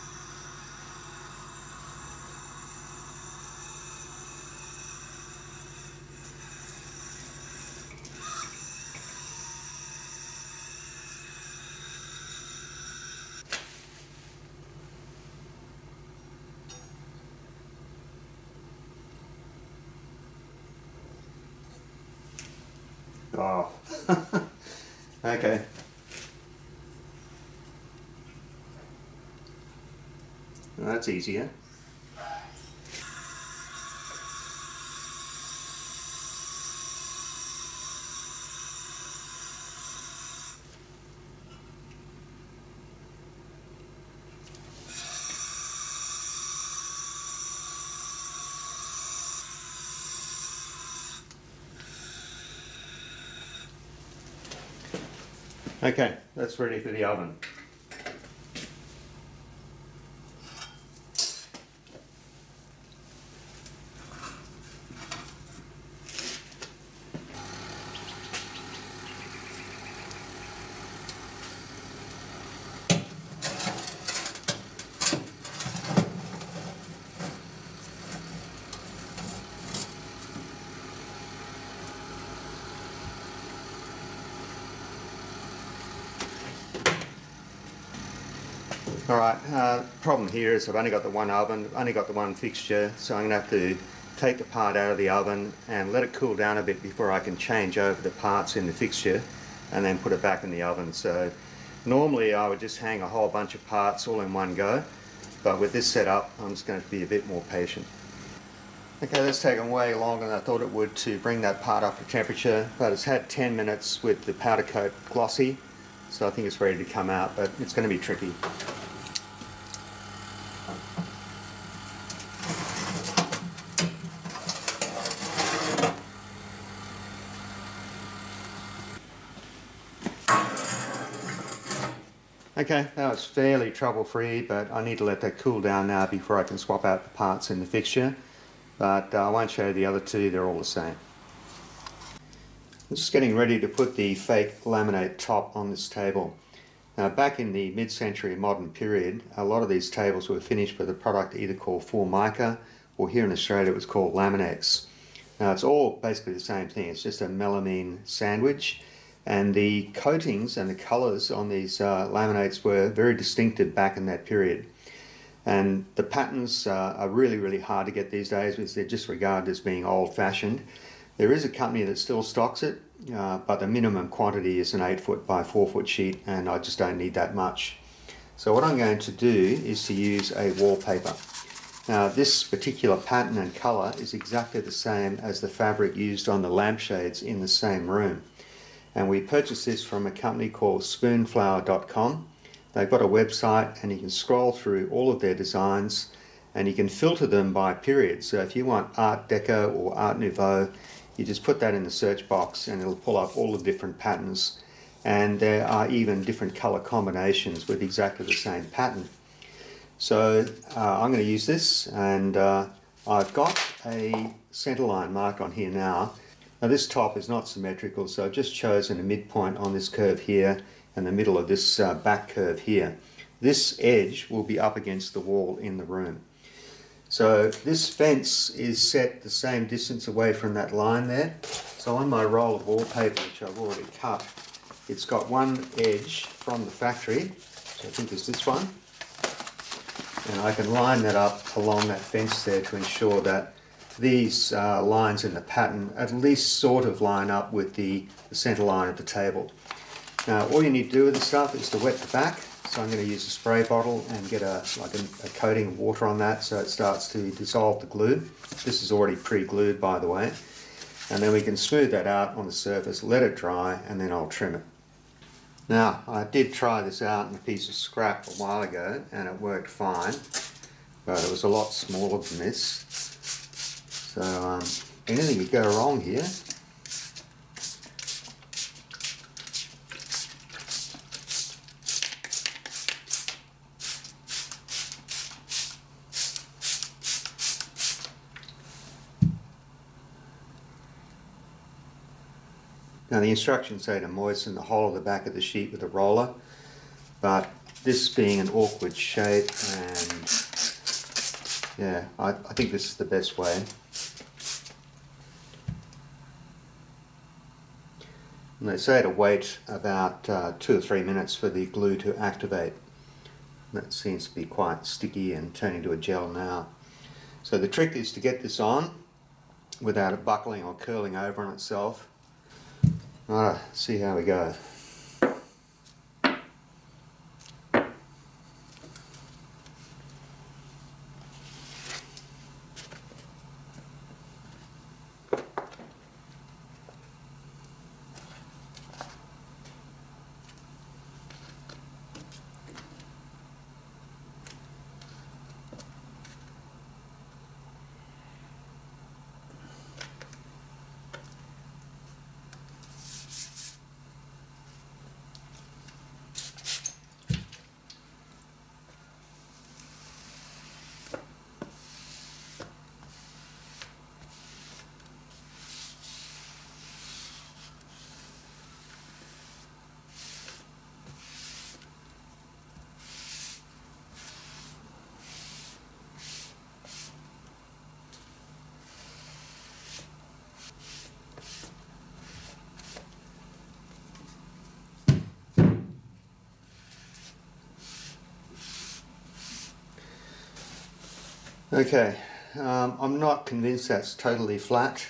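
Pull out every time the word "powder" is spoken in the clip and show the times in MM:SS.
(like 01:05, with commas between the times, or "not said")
01:54.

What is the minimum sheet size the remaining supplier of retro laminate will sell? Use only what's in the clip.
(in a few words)
8 foot by 4 foot.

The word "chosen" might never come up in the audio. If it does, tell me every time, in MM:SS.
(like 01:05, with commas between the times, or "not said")
03:38.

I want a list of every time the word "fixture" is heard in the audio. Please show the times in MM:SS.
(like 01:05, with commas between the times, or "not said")
01:32, 01:38, 02:17.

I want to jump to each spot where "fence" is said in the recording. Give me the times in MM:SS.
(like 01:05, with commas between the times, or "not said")
03:47, 04:01.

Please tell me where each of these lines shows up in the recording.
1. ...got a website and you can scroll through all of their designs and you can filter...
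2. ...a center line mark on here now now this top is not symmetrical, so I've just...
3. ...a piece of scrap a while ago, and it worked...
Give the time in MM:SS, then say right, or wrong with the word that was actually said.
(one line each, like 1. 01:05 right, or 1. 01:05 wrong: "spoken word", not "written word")
1. 03:12 right
2. 03:33 right
3. 04:27 right.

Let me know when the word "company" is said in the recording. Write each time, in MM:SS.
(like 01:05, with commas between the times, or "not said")
02:51, 03:10.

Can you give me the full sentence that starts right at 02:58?
So, what I'm going to do is to use a wallpaper.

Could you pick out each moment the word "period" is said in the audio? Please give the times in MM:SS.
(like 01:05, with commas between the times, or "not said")
02:28, 02:44, 03:17.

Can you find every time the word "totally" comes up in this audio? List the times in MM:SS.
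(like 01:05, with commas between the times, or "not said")
06:34.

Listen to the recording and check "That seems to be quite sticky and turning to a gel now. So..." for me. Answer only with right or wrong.
right.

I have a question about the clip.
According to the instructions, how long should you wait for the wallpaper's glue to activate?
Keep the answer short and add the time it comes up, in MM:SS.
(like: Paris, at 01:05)
2 or 3 minutes, at 05:10.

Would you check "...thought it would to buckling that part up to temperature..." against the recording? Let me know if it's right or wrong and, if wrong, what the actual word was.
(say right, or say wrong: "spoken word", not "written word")
wrong: "bring", not "buckling".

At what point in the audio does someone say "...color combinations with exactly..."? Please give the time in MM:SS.
03:26.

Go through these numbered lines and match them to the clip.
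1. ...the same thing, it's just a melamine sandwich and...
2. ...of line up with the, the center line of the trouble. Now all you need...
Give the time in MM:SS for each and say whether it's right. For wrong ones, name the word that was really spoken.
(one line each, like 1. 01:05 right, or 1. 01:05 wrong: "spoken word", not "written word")
1. 02:36 right
2. 04:06 wrong: "table", not "trouble".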